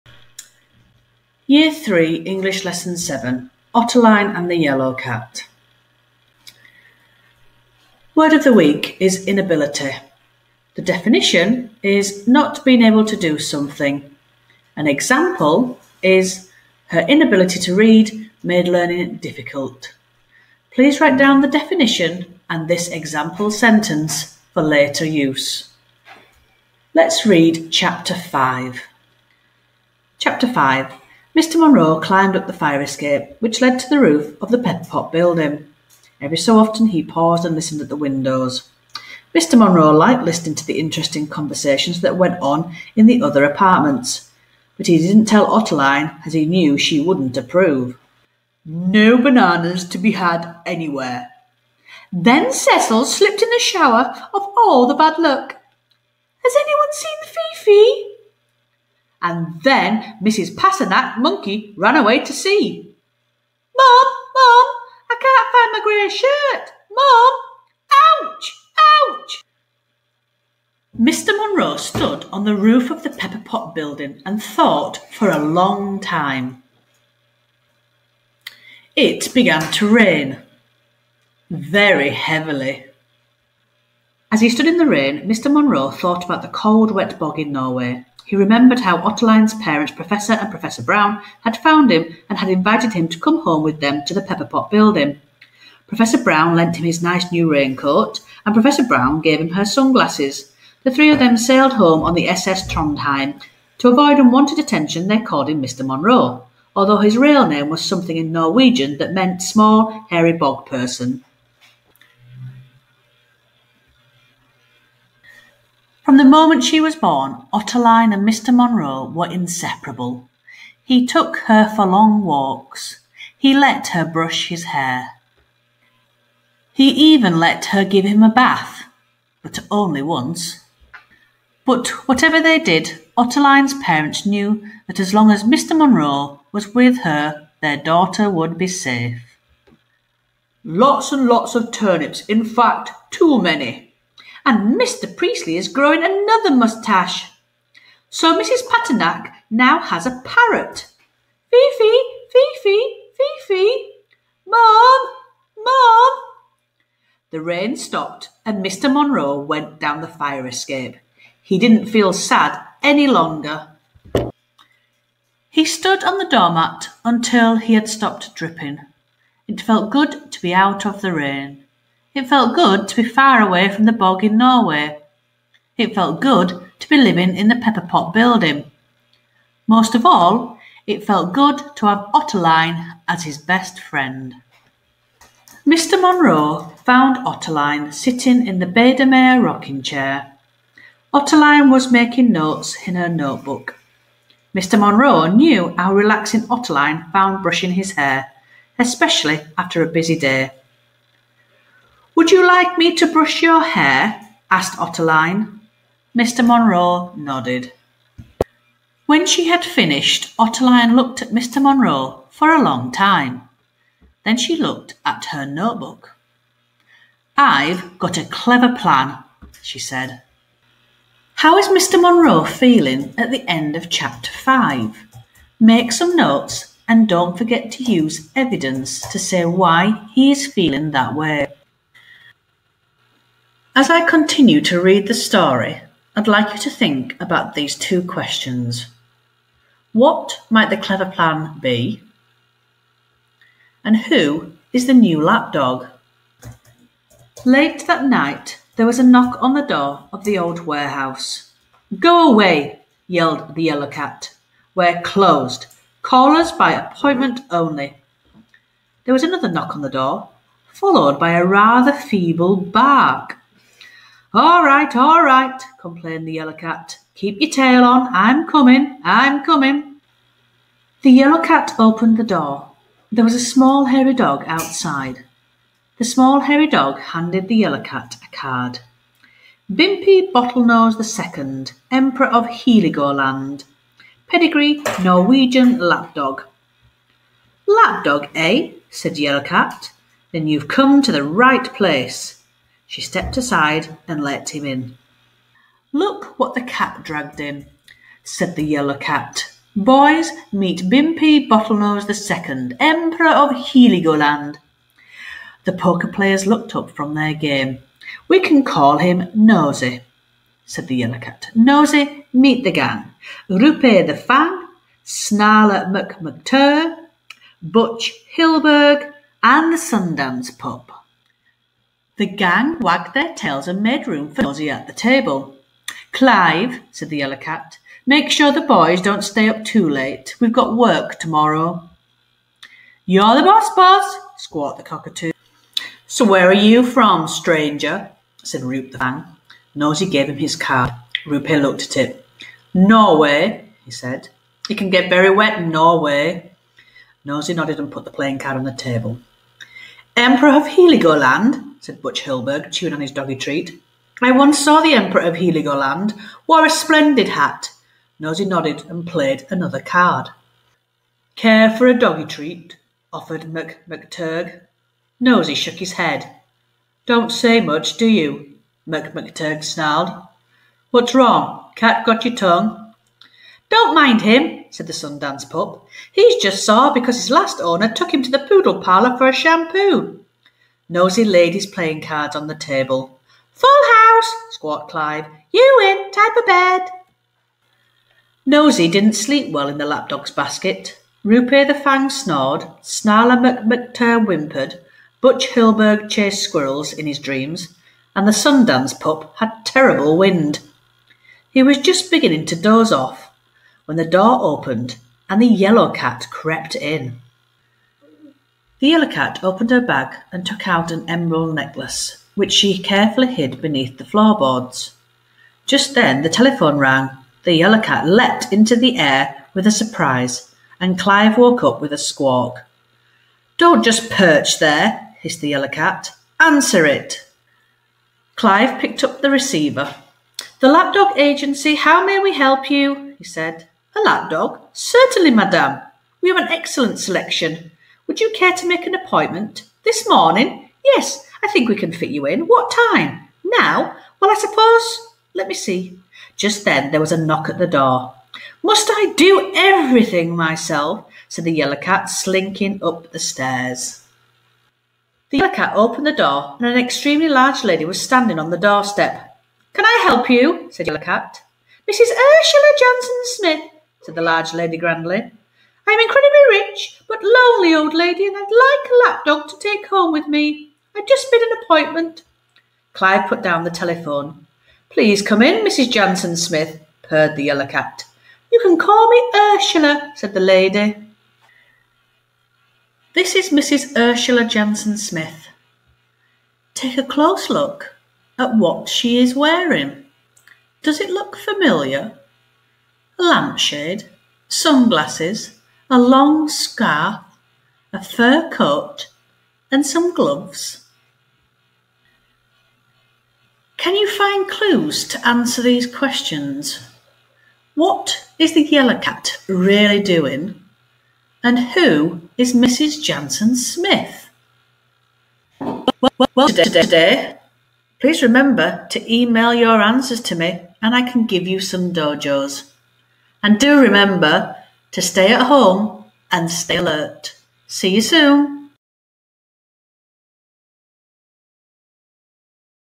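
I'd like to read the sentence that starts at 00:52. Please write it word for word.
Then Cecil slipped in the shower of all the bad luck.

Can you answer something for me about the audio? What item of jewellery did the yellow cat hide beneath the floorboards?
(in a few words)
emerald necklace.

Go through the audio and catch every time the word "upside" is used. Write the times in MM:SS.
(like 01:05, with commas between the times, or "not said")
not said.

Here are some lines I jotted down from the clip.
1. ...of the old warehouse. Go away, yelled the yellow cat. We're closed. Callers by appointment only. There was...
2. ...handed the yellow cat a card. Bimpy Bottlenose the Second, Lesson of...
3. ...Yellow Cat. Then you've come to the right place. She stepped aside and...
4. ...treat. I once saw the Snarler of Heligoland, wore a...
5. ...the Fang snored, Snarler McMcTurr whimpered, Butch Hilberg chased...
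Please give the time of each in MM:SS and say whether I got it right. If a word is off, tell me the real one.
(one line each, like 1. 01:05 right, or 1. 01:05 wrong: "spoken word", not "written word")
1. 04:10 right
2. 04:36 wrong: "Emperor", not "Lesson"
3. 04:49 right
4. 05:53 wrong: "Emperor", not "Snarler"
5. 06:31 right.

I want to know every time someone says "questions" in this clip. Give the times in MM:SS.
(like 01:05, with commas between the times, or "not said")
03:58, 08:25.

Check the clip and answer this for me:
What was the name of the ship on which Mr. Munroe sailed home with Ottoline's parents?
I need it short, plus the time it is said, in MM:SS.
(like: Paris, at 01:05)
SS Trondheim, at 01:42.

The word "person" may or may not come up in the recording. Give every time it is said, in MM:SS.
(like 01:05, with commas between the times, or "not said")
01:50.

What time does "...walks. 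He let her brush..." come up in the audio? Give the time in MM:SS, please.
02:02.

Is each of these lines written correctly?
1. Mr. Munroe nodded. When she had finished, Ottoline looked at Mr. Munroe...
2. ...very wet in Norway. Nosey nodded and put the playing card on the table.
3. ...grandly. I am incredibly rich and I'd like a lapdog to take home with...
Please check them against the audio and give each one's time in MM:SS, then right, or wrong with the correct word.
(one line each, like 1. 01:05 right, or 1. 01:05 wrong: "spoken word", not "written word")
1. 03:26 right
2. 05:45 right
3. 07:44 right.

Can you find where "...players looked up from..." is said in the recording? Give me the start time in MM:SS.
05:06.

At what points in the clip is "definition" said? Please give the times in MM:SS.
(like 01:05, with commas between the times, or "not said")
00:10, 00:21.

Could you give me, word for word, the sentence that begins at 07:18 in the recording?
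Would you care to make an appointment?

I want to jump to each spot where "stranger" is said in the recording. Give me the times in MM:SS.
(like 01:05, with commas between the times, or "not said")
05:37.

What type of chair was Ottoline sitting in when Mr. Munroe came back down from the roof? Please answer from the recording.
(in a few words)
Biedermeier rocking chair.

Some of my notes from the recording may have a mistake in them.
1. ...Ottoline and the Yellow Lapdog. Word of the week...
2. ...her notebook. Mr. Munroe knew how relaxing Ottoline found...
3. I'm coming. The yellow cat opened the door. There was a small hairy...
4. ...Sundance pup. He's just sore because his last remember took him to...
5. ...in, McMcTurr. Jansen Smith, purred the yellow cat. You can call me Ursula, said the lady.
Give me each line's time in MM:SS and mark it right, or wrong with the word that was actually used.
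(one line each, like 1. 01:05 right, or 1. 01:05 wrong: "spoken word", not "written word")
1. 00:03 wrong: "Cat", not "Lapdog"
2. 03:12 right
3. 04:29 right
4. 06:14 wrong: "owner", not "remember"
5. 07:55 wrong: "Mrs", not "McMcTurr".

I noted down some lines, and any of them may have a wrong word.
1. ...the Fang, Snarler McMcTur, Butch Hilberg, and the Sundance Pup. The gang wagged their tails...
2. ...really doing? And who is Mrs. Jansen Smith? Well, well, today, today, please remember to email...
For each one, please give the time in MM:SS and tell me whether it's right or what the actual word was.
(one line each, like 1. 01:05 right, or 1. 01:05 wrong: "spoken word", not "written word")
1. 05:14 right
2. 08:29 right.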